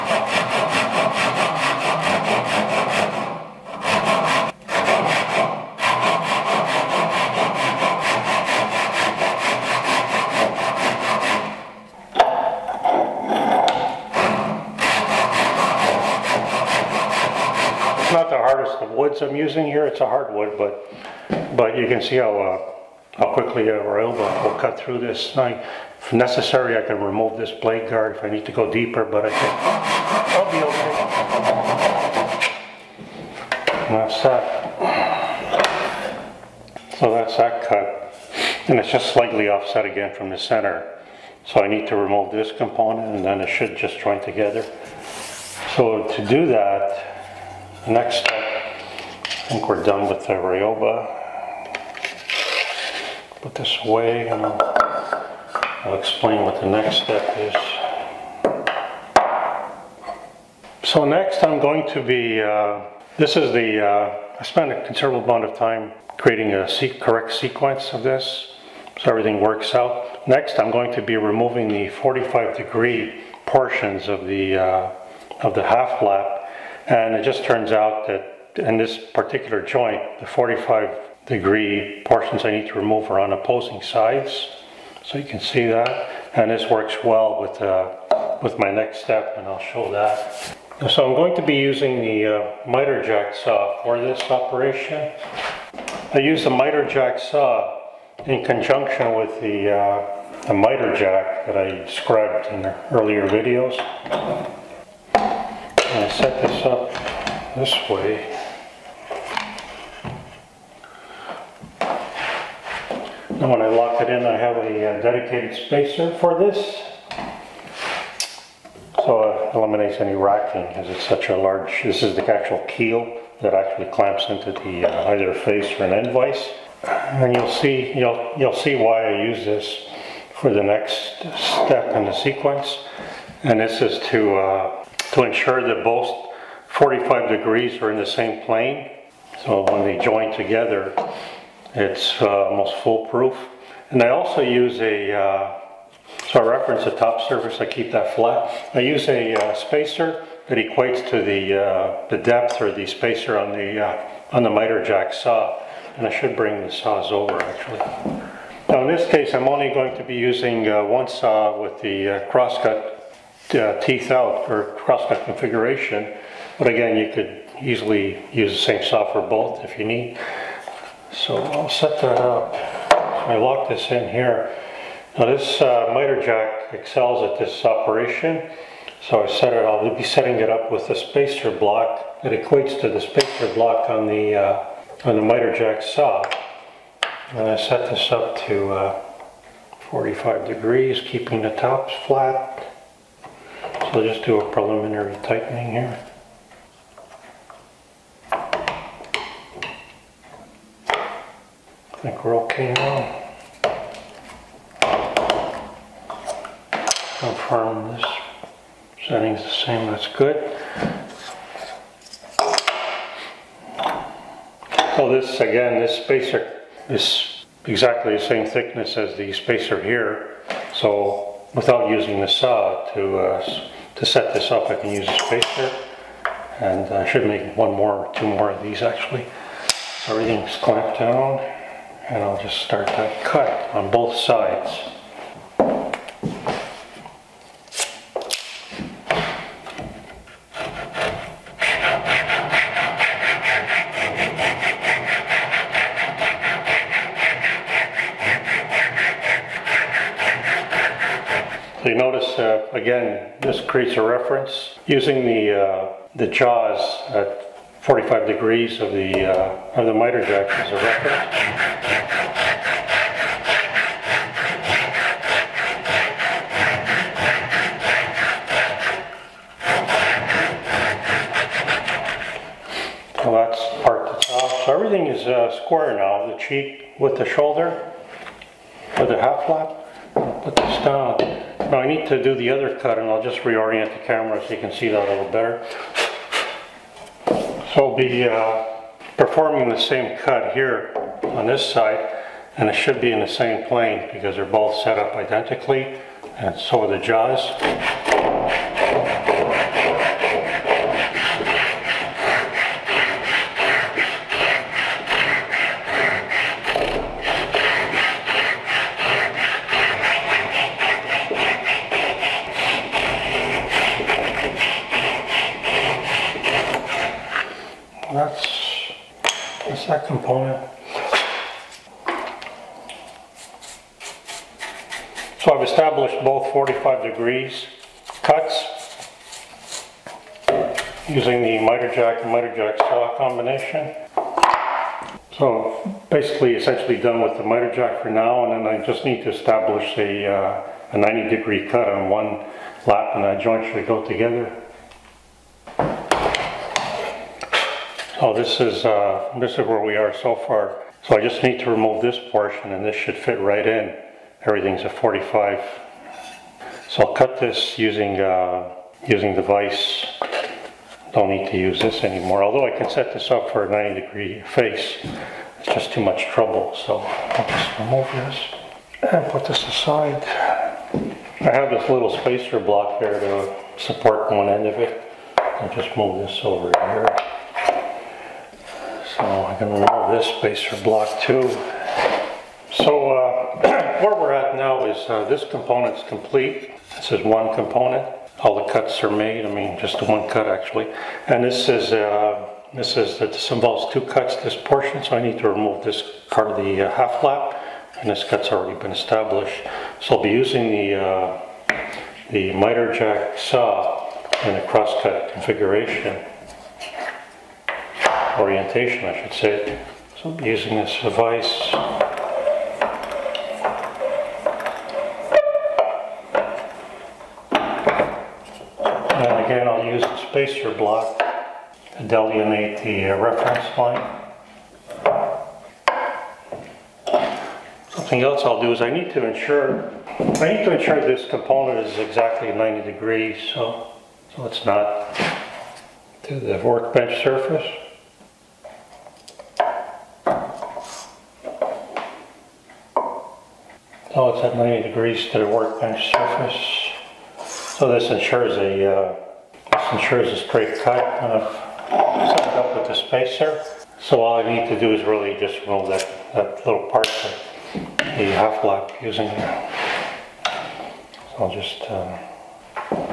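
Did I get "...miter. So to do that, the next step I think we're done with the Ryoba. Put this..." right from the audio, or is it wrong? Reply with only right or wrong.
wrong.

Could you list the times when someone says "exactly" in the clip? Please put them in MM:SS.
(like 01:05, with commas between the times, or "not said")
03:37, 07:11.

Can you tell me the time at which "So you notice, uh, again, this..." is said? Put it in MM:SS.
04:11.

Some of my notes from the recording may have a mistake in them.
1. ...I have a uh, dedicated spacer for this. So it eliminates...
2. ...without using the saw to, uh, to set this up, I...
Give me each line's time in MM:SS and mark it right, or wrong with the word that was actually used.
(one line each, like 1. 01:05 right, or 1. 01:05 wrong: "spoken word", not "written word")
1. 01:54 right
2. 03:41 right.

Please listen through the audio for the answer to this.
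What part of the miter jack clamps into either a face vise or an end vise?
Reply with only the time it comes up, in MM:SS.
02:02.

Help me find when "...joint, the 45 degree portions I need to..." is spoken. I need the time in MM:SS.
01:19.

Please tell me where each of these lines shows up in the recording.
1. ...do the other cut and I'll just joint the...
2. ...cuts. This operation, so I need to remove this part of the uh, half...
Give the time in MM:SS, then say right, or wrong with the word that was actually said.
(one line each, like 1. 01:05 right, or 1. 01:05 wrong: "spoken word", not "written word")
1. 04:42 wrong: "reorient", not "joint"
2. 06:34 wrong: "portion", not "operation".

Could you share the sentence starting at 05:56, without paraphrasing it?
So I'll cut this using, uh, using the vise.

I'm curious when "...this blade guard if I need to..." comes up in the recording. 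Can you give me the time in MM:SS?
00:27.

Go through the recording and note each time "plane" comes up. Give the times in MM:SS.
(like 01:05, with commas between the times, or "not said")
02:18, 04:53.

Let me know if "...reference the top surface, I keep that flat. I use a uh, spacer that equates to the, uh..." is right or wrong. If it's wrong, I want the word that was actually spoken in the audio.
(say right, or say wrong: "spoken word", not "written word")
right.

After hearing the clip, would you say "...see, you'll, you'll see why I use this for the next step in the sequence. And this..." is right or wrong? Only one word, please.
right.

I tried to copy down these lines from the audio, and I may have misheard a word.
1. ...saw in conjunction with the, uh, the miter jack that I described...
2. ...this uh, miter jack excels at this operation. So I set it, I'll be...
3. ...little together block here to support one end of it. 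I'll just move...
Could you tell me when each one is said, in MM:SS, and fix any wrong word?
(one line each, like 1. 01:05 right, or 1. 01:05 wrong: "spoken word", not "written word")
1. 01:37 right
2. 02:55 right
3. 06:11 wrong: "spacer", not "together".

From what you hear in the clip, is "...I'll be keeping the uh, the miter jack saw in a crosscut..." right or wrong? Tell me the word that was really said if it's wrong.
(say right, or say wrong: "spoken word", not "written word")
wrong: "using", not "keeping".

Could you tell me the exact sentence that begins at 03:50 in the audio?
So everything's clamped down and I'll just start to cut on both sides.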